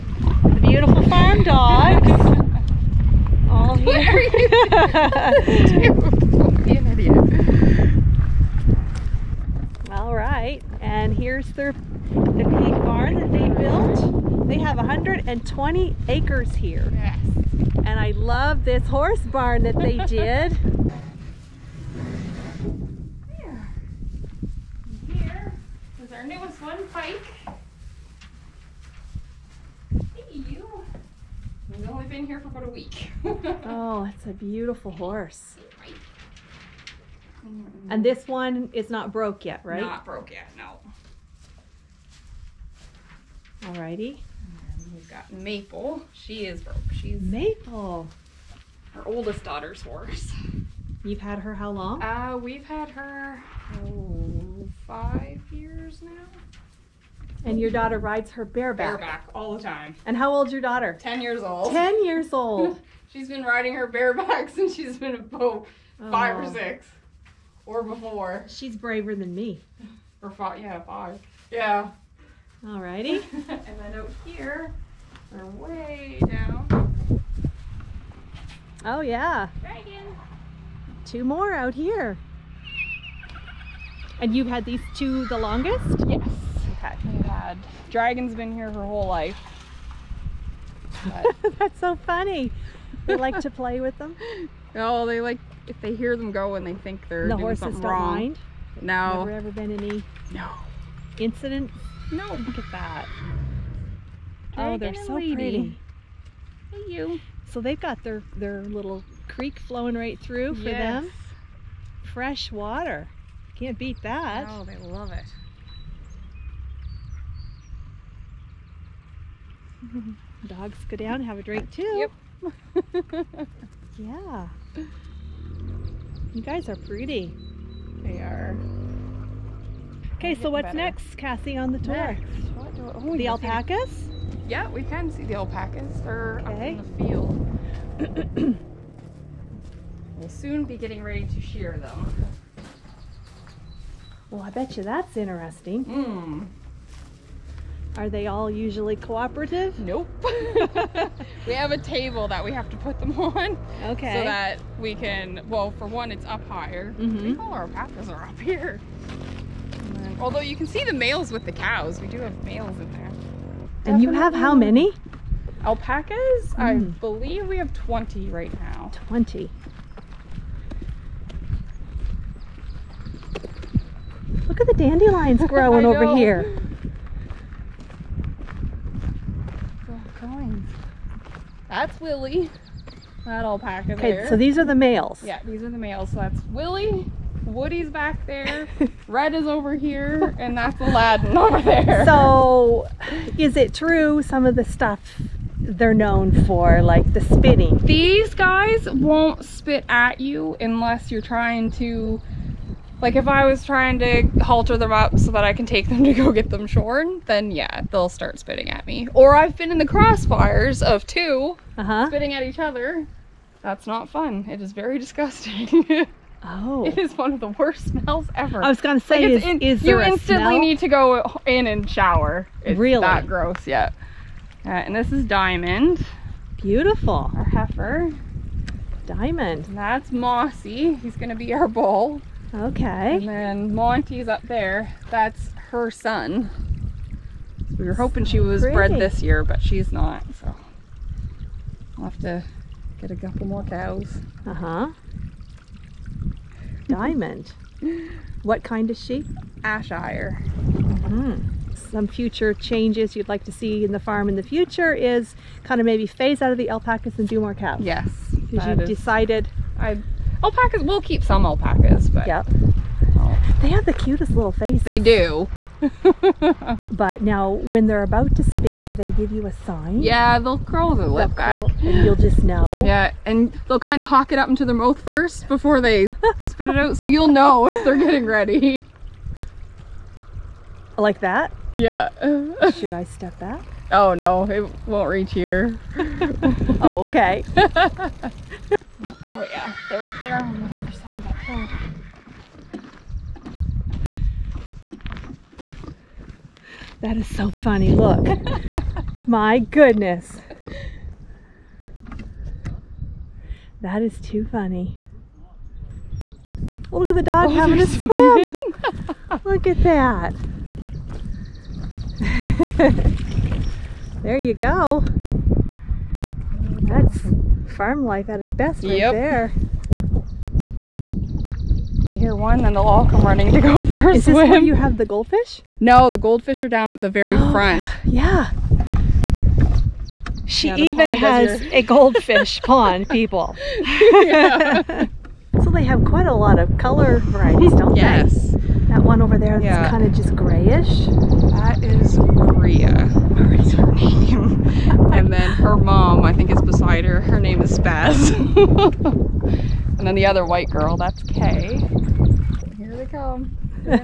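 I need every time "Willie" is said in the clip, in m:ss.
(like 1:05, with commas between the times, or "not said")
3:02, 3:06.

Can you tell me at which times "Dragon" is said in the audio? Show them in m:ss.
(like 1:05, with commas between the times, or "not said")
1:19, 1:27.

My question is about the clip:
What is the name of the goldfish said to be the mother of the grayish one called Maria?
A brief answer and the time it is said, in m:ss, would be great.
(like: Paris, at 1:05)
Spaz, at 5:47.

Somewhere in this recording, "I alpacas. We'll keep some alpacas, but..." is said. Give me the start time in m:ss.
4:19.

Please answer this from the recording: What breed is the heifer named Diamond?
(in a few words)
Ayrshire.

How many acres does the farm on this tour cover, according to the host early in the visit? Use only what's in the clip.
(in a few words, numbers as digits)
120.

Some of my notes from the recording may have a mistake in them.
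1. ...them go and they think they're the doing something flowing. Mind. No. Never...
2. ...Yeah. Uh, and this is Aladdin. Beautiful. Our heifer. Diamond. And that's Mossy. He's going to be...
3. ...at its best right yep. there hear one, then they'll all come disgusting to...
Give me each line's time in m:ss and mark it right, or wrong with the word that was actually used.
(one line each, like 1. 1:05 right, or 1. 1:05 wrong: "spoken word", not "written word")
1. 1:36 wrong: "wrong", not "flowing"
2. 3:43 wrong: "Diamond", not "Aladdin"
3. 5:18 wrong: "running", not "disgusting".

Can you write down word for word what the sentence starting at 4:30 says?
Yeah, they'll curl the lip back.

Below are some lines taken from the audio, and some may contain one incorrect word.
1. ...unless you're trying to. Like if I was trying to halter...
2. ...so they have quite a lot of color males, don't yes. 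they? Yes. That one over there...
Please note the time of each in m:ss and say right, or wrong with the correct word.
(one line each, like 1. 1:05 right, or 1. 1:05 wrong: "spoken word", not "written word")
1. 3:20 right
2. 5:35 wrong: "varieties", not "males".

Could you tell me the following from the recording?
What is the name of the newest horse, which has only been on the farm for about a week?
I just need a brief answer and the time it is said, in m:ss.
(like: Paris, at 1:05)
Pike, at 0:26.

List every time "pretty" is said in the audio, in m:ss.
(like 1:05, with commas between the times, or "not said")
1:45, 2:06, 3:58.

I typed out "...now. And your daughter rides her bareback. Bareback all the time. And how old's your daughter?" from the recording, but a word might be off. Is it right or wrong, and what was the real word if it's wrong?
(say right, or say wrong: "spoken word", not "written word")
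right.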